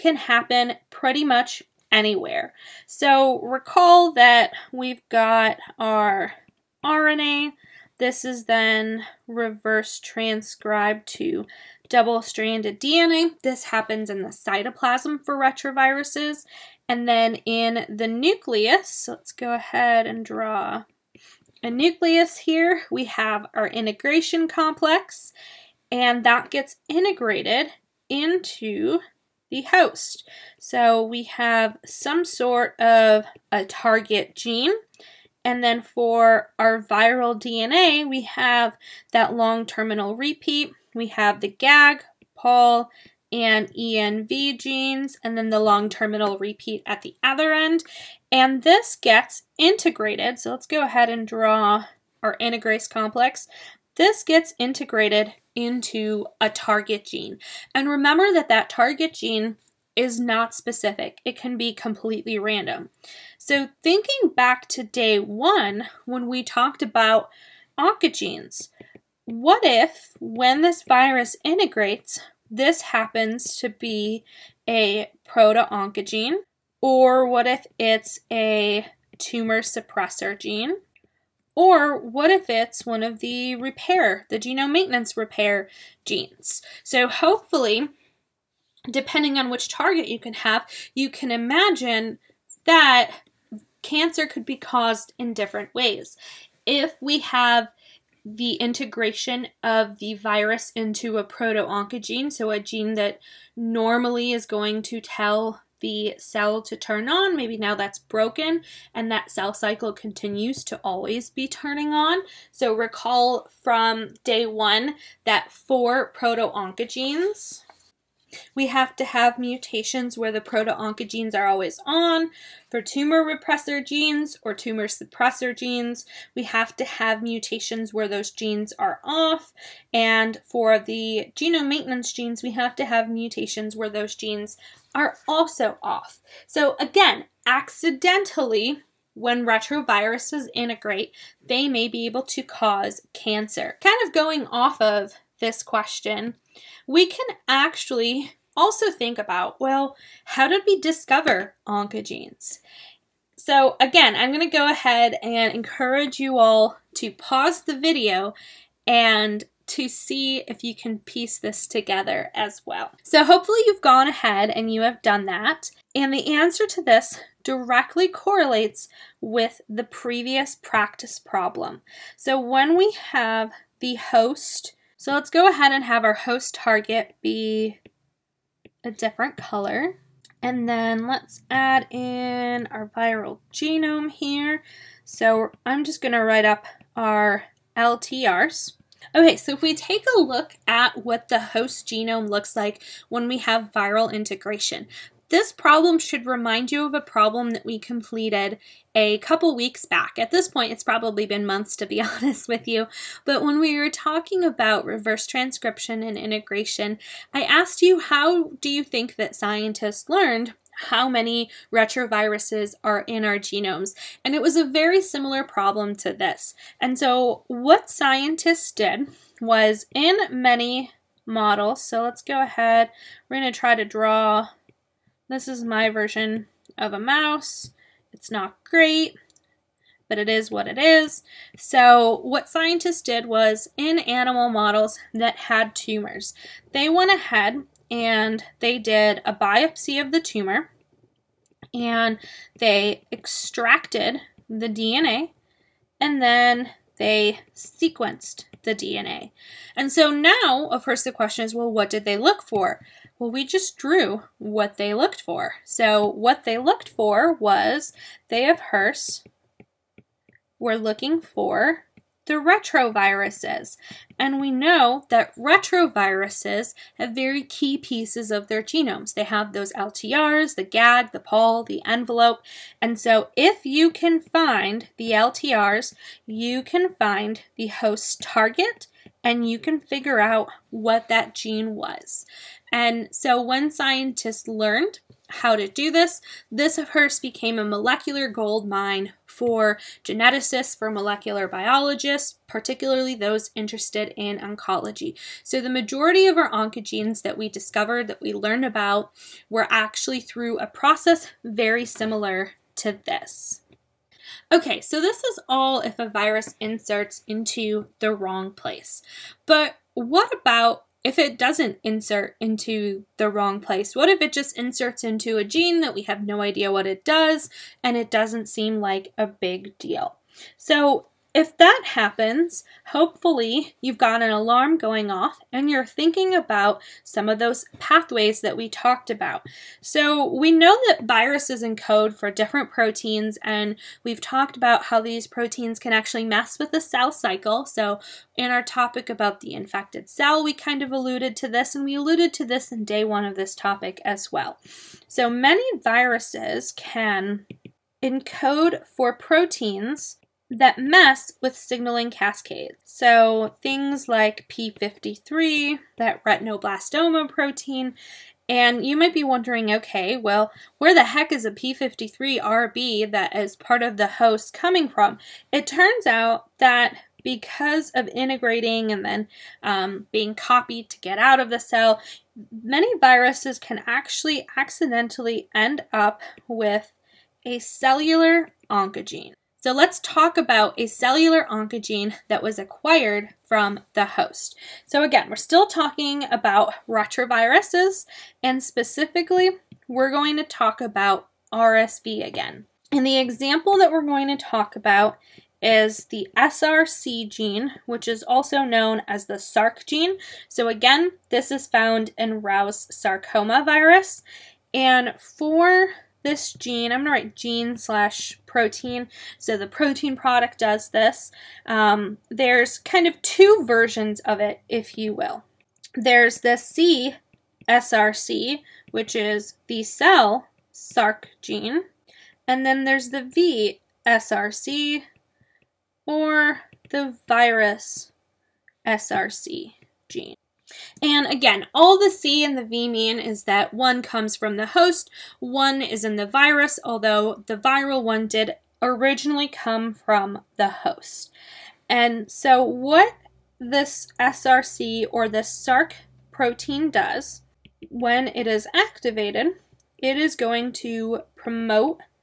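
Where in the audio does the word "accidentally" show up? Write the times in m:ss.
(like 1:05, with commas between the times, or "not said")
2:17, 6:14.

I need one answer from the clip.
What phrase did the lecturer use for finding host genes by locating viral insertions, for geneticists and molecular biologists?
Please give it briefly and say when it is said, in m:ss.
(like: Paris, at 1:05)
Molecular gold mine, at 4:47.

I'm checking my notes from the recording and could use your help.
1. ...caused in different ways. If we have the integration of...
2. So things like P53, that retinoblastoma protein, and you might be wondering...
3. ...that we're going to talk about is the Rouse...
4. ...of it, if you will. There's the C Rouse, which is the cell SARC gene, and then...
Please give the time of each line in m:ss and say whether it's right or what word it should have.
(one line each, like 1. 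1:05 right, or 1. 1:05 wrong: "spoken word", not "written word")
1. 1:34 right
2. 5:52 right
3. 6:33 wrong: "SRC", not "Rouse"
4. 6:54 wrong: "SRC", not "Rouse".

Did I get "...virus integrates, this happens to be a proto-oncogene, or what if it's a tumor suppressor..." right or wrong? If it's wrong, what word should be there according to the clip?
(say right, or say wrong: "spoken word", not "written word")
right.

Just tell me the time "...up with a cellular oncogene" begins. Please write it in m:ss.
6:15.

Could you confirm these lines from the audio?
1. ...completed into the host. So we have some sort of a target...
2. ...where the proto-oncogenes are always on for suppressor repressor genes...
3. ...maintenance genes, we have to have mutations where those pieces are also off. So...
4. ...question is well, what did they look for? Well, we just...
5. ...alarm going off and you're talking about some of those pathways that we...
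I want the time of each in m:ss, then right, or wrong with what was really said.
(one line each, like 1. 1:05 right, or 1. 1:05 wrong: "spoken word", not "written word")
1. 0:26 wrong: "integrated", not "completed"
2. 2:00 wrong: "tumor", not "suppressor"
3. 2:11 wrong: "genes", not "pieces"
4. 4:11 right
5. 5:24 wrong: "thinking", not "talking".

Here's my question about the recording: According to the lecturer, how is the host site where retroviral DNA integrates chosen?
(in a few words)
Completely random.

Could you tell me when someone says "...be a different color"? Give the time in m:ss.
2:57.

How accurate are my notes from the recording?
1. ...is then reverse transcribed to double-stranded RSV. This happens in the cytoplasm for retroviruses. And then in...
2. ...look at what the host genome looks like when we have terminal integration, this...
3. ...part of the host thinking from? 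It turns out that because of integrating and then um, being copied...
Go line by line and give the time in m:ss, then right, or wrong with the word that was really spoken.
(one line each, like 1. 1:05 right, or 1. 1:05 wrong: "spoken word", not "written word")
1. 0:08 wrong: "DNA", not "RSV"
2. 3:10 wrong: "viral", not "terminal"
3. 6:03 wrong: "coming", not "thinking".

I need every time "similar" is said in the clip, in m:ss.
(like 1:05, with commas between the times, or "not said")
3:35, 5:01.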